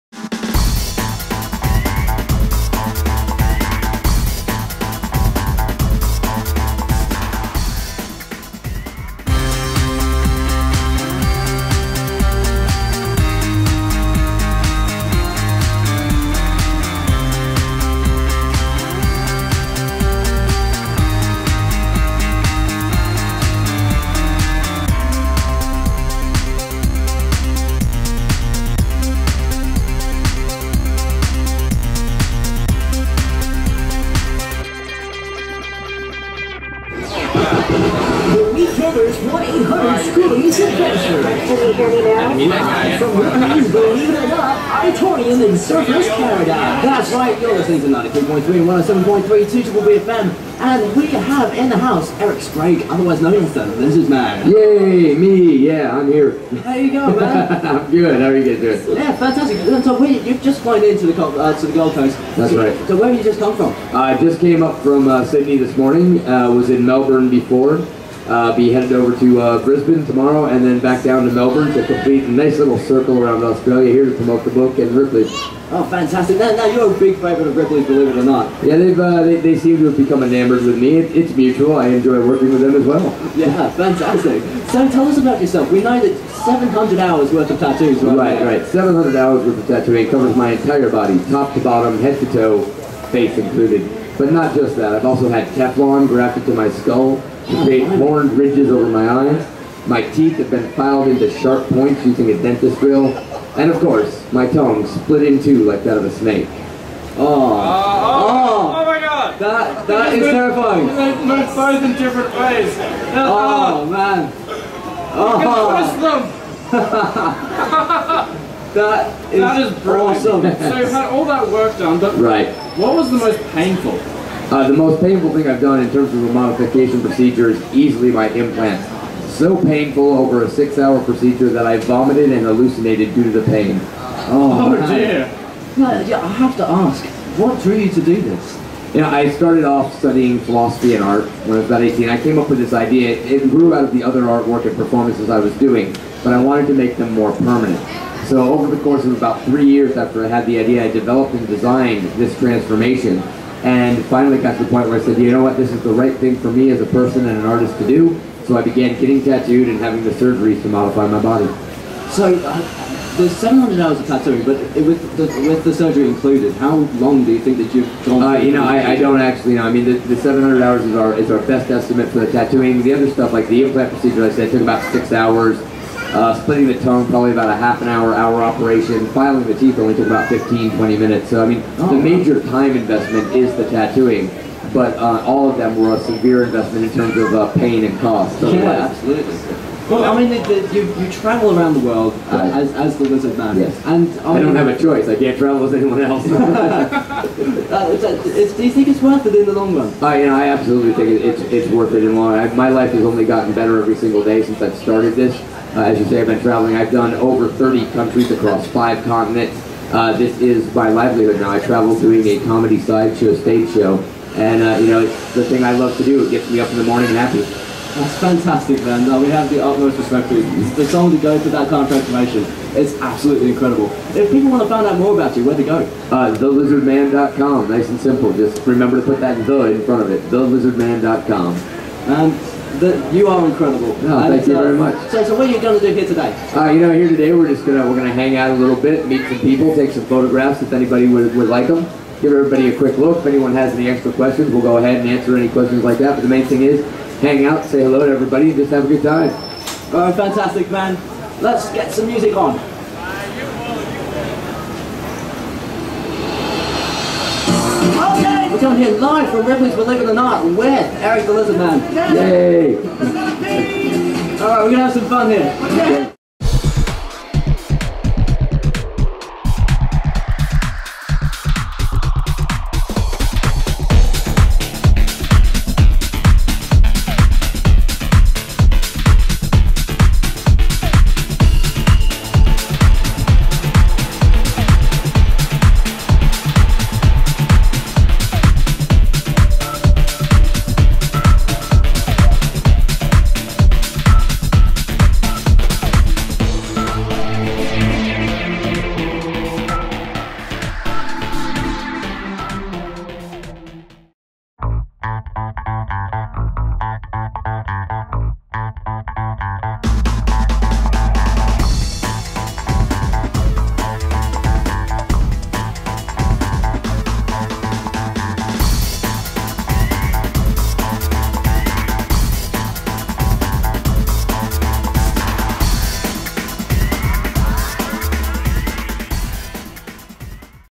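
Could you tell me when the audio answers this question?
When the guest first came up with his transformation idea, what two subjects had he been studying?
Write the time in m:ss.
2:20.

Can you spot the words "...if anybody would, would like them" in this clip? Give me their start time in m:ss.
4:00.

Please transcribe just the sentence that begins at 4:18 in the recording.
Okay here live from Ripley's Believe It or Not with Eric the Lizard Man.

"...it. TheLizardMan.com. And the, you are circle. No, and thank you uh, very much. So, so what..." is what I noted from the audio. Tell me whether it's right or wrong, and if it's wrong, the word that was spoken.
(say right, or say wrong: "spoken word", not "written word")
wrong: "incredible", not "circle".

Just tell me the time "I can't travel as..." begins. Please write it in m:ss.
3:15.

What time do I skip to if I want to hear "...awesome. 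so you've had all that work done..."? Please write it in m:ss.
1:59.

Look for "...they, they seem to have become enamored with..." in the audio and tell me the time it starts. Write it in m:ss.
1:19.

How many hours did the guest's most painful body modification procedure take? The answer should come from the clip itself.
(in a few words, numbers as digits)
6 hours.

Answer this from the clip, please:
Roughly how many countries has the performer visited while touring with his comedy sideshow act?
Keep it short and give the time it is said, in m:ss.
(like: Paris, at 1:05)
Over 30, at 3:27.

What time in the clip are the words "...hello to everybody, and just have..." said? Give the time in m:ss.
4:07.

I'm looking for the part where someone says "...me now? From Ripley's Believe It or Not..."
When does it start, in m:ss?
0:42.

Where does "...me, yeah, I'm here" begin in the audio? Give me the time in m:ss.
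0:55.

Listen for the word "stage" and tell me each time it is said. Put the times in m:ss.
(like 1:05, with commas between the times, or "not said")
3:33.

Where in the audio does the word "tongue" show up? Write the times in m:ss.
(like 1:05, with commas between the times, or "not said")
1:44, 2:56.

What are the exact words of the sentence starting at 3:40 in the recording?
The song to go through that kind of transformation is absolutely incredible.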